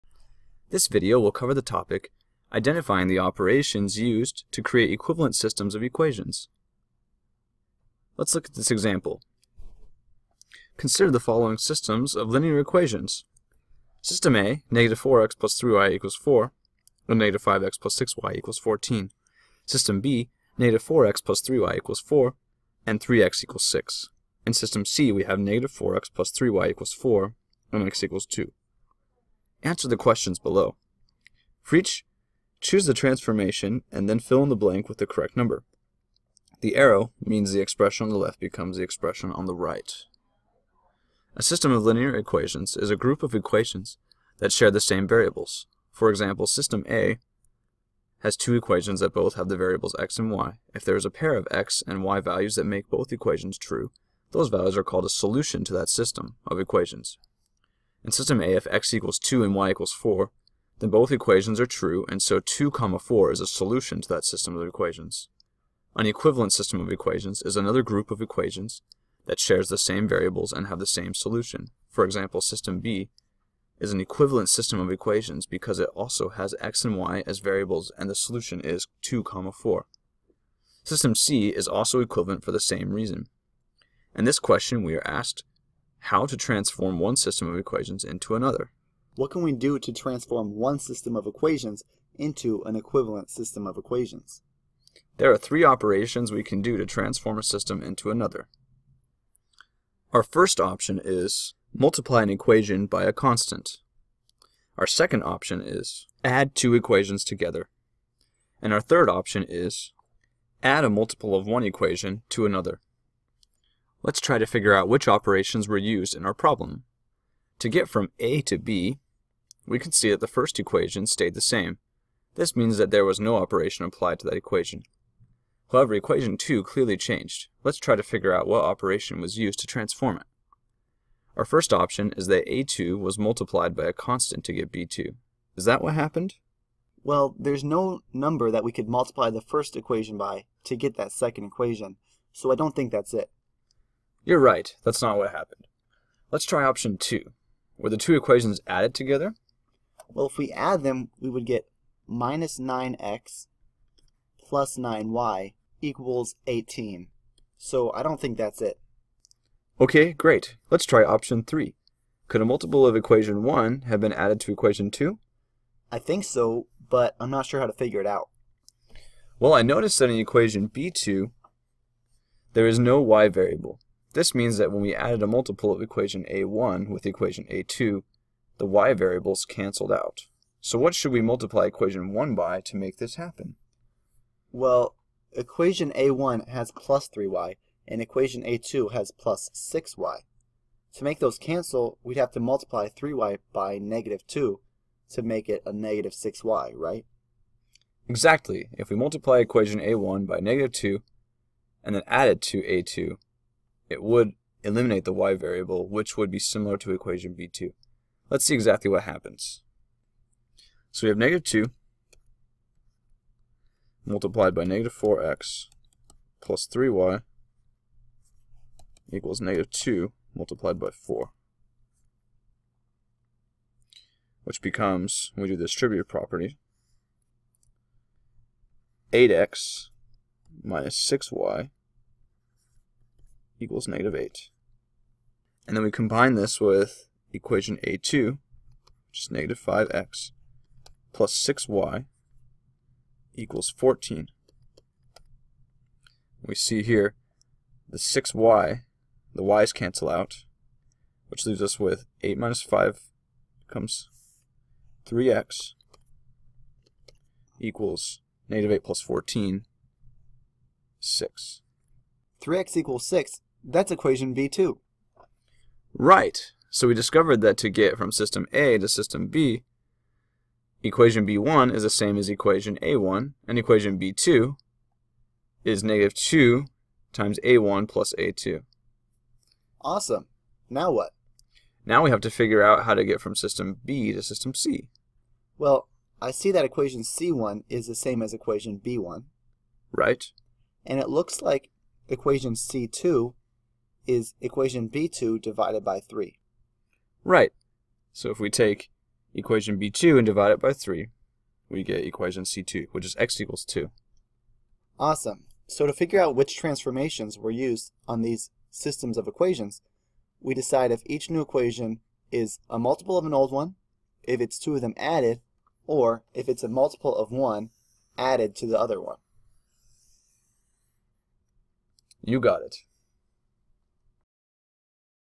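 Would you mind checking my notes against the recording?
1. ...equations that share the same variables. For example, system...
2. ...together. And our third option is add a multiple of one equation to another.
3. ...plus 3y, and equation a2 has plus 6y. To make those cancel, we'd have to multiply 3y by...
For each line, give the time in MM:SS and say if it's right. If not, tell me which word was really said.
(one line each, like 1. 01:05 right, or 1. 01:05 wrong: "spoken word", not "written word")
1. 00:43 right
2. 01:47 right
3. 03:06 right.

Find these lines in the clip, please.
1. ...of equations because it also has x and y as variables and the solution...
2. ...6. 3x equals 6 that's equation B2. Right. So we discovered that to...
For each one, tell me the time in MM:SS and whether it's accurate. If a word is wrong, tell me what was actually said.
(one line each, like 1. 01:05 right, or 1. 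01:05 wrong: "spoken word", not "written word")
1. 01:14 right
2. 04:20 right.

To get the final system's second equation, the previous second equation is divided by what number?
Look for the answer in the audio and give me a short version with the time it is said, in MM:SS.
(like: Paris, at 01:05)
3, at 04:55.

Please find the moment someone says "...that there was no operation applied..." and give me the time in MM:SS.
02:02.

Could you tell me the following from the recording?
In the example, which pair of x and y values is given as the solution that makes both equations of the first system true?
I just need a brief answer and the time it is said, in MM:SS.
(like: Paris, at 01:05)
2, 4, at 01:02.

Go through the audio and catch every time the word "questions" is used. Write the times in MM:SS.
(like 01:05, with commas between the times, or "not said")
00:29, 01:24.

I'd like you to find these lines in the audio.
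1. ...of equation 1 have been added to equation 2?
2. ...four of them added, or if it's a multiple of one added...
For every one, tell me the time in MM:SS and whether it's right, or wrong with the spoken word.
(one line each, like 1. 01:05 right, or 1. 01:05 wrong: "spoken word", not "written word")
1. 02:42 right
2. 05:14 wrong: "two", not "four".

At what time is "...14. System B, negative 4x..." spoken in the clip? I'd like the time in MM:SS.
00:18.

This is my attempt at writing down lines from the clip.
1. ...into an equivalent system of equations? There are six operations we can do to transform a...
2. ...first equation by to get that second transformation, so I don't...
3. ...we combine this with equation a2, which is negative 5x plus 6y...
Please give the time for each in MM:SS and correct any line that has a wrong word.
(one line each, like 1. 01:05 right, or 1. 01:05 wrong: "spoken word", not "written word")
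1. 01:32 wrong: "three", not "six"
2. 02:19 wrong: "equation", not "transformation"
3. 03:55 right.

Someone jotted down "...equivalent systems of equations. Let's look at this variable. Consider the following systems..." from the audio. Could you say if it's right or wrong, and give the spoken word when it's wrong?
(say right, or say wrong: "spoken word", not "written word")
wrong: "example", not "variable".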